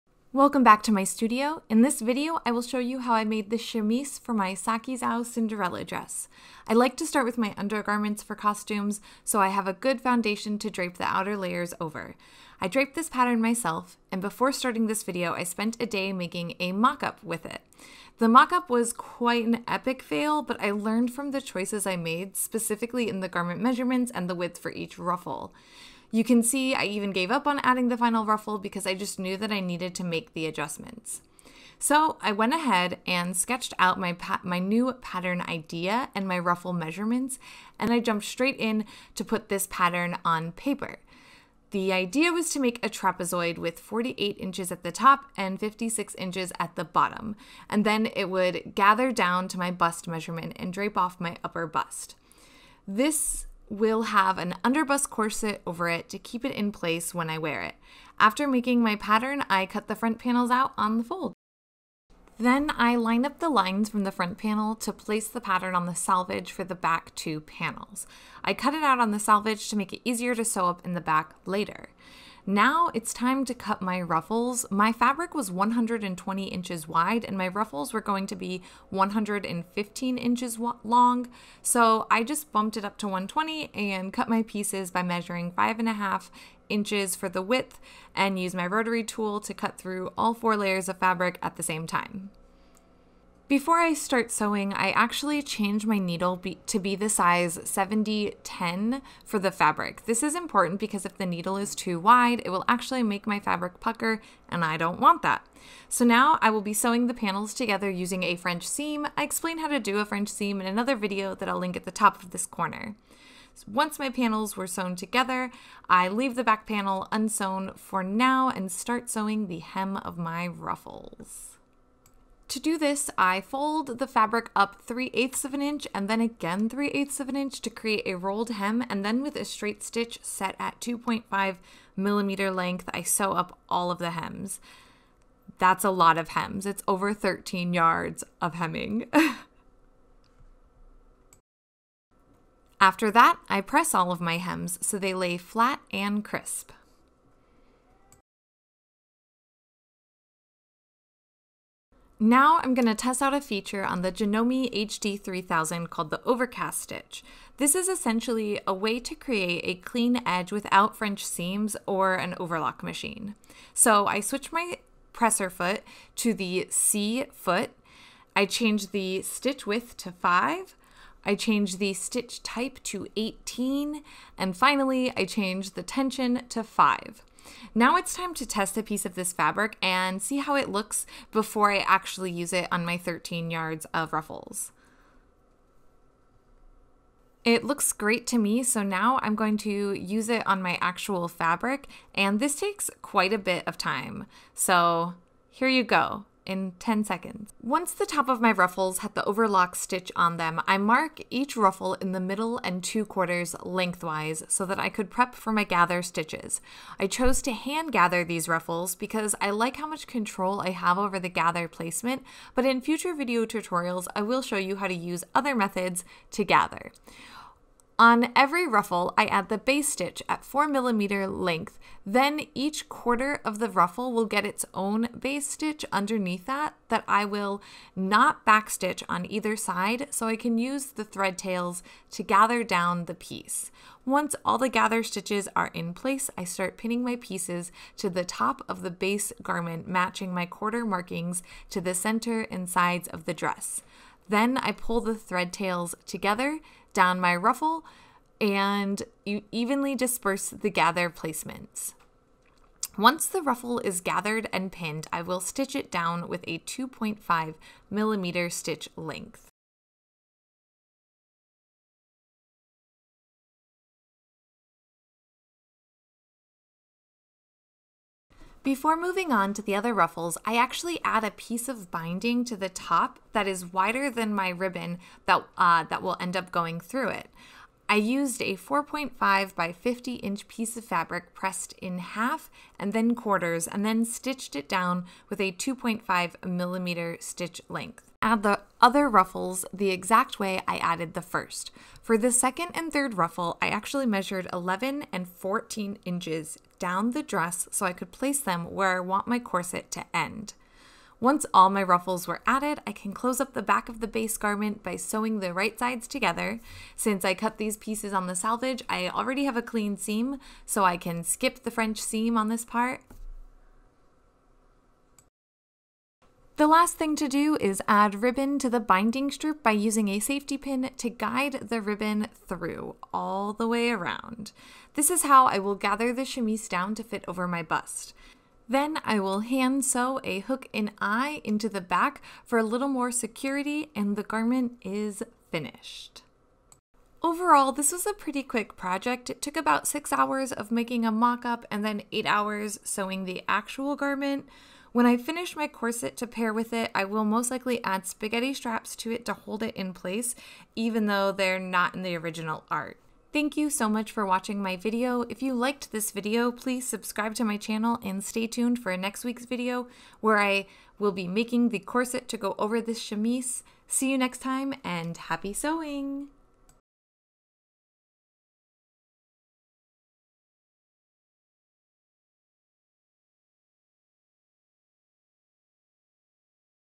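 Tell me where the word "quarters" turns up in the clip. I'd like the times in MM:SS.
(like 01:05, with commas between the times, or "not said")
03:23, 03:42, 04:00, 04:43.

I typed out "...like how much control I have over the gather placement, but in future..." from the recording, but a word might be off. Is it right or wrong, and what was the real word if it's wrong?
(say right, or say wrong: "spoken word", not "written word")
right.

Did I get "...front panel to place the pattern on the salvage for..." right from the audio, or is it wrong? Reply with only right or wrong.
right.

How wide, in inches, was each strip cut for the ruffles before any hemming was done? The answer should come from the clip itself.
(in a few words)
5.5 inches.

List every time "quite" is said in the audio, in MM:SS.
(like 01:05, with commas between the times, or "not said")
00:18, 03:13.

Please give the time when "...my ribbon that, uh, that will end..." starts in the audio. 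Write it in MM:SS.
04:34.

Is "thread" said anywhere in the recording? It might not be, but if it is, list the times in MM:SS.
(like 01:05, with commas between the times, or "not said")
03:51, 04:05.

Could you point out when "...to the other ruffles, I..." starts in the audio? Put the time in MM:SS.
04:29.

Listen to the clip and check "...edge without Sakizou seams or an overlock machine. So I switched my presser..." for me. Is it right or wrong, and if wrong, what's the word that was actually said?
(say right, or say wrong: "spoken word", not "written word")
wrong: "French", not "Sakizou".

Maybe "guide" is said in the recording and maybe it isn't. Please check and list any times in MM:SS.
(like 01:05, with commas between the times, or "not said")
05:21.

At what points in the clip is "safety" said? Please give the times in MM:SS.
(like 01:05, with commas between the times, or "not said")
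05:20.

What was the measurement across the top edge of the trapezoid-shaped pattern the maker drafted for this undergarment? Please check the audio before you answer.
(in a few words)
48 inches.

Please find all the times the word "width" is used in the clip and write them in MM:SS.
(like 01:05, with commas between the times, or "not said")
00:24, 01:27, 02:49.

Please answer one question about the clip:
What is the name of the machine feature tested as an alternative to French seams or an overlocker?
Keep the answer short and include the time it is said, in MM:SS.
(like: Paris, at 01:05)
Overcast Stitch, at 02:36.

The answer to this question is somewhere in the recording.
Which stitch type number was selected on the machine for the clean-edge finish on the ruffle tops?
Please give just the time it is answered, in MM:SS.
02:53.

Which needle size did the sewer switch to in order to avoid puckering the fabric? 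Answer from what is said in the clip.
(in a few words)
70-10.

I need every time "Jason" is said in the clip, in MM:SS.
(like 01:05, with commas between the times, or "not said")
not said.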